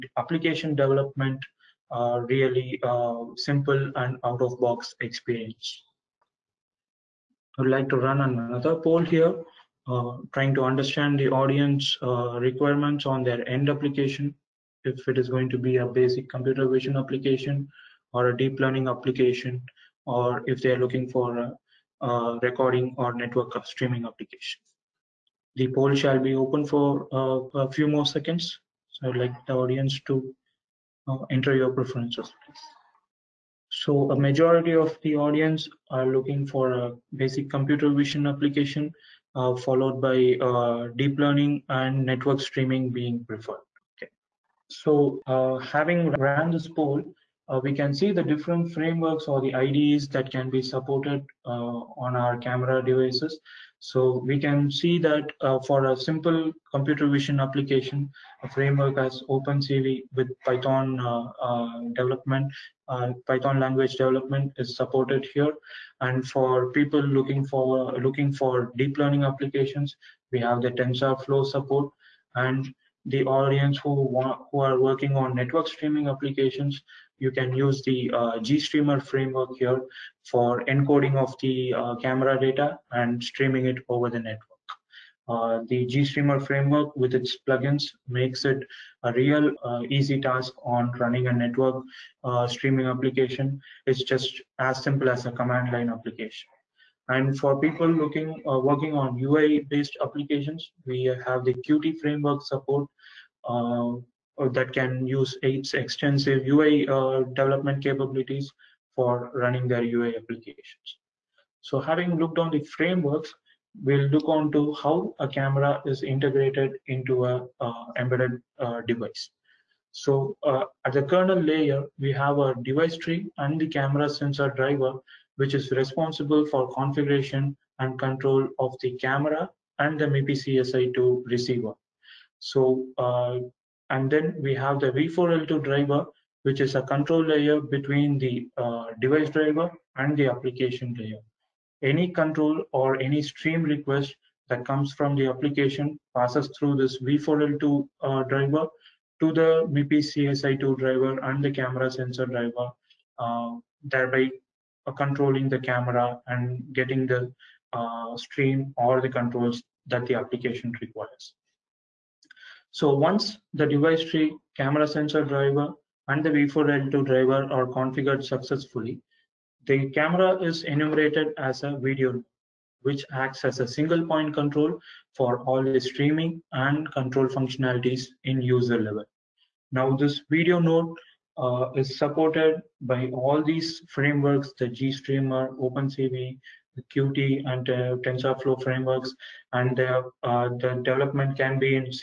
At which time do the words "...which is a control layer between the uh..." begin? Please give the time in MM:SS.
02:16.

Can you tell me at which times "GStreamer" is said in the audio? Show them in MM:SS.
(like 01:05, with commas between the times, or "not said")
01:18, 01:25, 03:04.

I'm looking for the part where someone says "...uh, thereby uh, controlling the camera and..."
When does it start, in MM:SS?
02:33.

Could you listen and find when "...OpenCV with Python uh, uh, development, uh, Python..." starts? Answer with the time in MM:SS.
00:59.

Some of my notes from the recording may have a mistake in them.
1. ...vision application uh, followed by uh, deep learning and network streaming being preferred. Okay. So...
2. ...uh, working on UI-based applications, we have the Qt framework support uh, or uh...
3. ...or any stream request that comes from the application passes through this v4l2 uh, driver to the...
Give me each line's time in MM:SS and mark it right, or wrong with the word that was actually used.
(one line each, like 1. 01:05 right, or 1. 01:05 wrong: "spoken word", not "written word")
1. 00:37 right
2. 01:38 right
3. 02:22 right.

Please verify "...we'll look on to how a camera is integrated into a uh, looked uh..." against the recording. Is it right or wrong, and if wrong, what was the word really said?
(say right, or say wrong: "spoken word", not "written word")
wrong: "embedded", not "looked".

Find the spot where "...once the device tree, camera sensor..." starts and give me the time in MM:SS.
02:42.